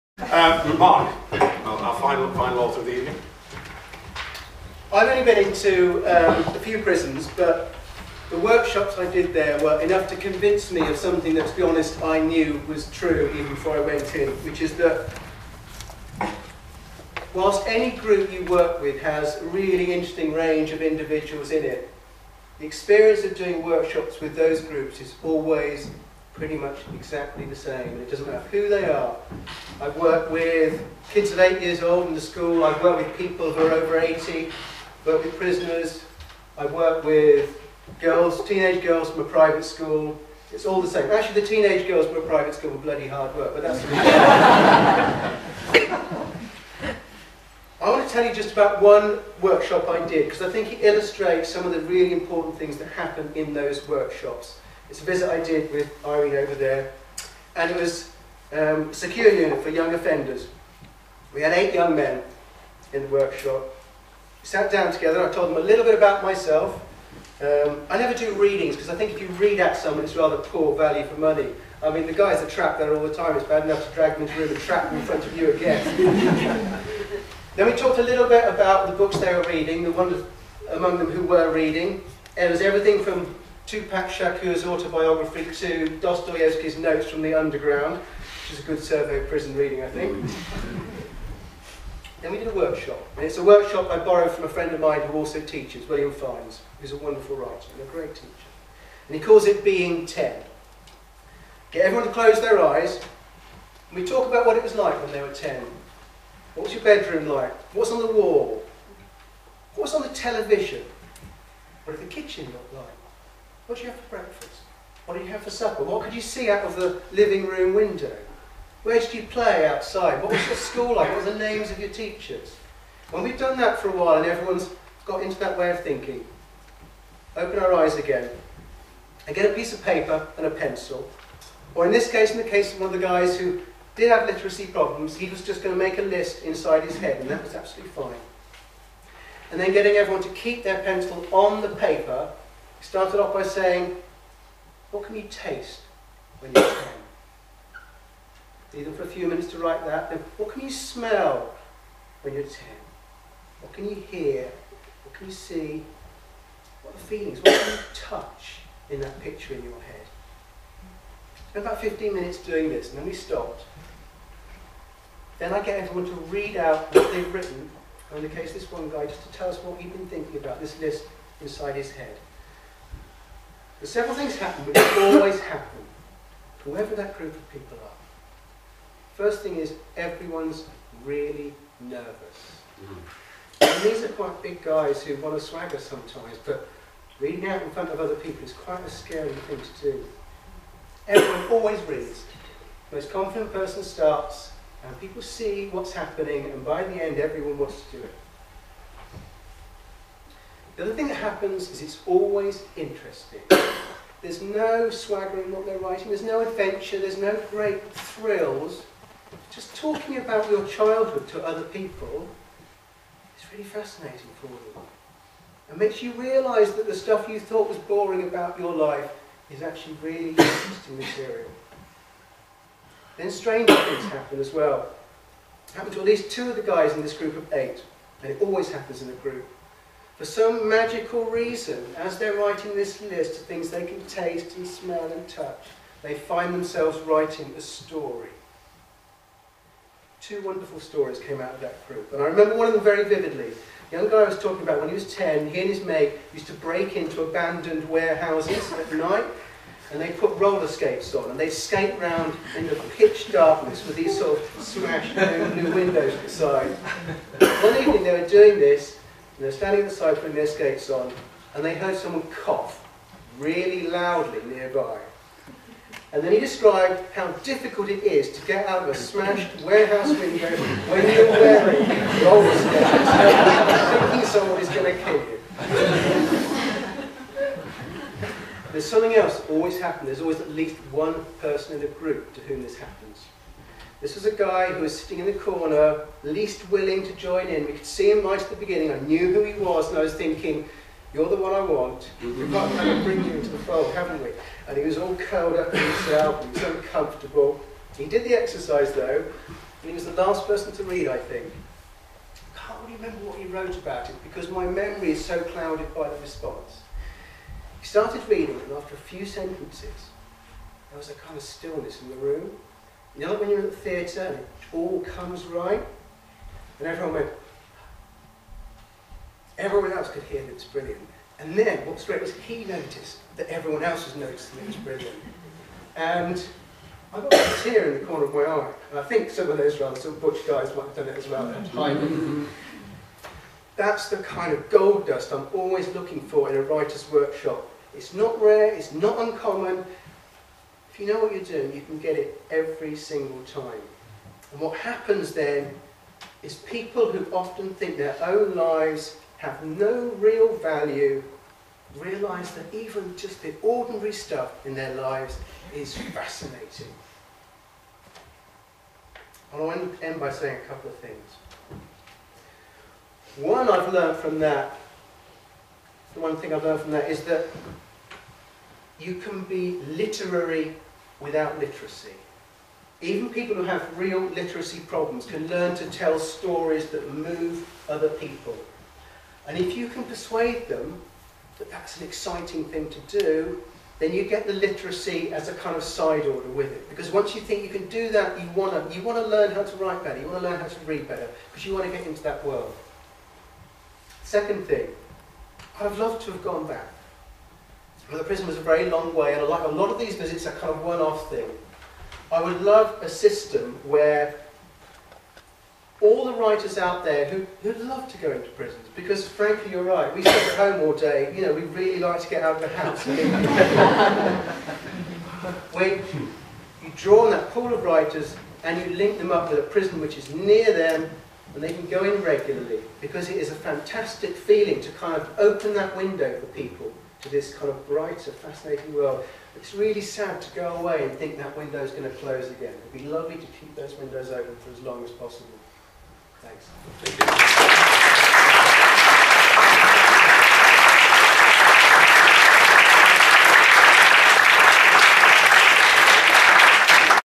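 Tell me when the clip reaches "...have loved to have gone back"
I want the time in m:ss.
6:35.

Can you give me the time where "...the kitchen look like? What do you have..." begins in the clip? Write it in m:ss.
1:52.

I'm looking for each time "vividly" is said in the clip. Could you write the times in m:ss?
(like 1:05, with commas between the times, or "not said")
4:03.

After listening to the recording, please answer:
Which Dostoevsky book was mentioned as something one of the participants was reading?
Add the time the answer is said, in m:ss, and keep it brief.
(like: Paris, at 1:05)
Notes from the Underground, at 1:26.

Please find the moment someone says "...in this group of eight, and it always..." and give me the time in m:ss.
3:46.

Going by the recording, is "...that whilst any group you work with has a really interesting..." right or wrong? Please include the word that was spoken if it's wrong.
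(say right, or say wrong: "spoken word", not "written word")
right.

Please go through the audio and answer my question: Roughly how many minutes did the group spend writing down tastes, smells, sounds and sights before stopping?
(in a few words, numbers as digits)
15.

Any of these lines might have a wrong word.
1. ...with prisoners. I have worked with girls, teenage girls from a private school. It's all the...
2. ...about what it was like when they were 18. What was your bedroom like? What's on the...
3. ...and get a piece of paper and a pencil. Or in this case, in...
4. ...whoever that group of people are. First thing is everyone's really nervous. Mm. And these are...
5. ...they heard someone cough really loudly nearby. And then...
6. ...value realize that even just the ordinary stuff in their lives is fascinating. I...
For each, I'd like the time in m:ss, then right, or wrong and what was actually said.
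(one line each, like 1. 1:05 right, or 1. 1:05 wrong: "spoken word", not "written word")
1. 0:35 right
2. 1:44 wrong: "10", not "18"
3. 2:09 right
4. 2:56 right
5. 4:21 right
6. 5:50 right.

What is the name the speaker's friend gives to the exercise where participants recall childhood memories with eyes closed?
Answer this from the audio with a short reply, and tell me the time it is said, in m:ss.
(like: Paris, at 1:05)
Being 10, at 1:39.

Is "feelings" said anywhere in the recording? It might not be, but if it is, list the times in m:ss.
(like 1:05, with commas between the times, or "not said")
2:37, 7:04.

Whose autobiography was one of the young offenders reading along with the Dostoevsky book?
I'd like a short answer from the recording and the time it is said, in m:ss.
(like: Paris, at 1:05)
Tupac Shakur, at 1:23.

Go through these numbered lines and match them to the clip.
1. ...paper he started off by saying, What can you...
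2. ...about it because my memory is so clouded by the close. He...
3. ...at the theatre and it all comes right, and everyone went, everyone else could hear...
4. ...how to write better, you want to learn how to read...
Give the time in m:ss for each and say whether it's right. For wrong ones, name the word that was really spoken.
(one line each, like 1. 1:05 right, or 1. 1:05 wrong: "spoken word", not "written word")
1. 2:21 right
2. 5:03 wrong: "response", not "close"
3. 5:13 right
4. 6:29 right.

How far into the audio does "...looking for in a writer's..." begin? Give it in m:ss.
5:35.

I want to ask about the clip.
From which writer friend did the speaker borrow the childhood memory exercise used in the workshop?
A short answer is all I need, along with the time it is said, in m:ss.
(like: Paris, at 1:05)
William Fiennes, at 1:35.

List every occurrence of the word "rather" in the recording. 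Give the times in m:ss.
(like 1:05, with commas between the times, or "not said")
1:10, 5:29.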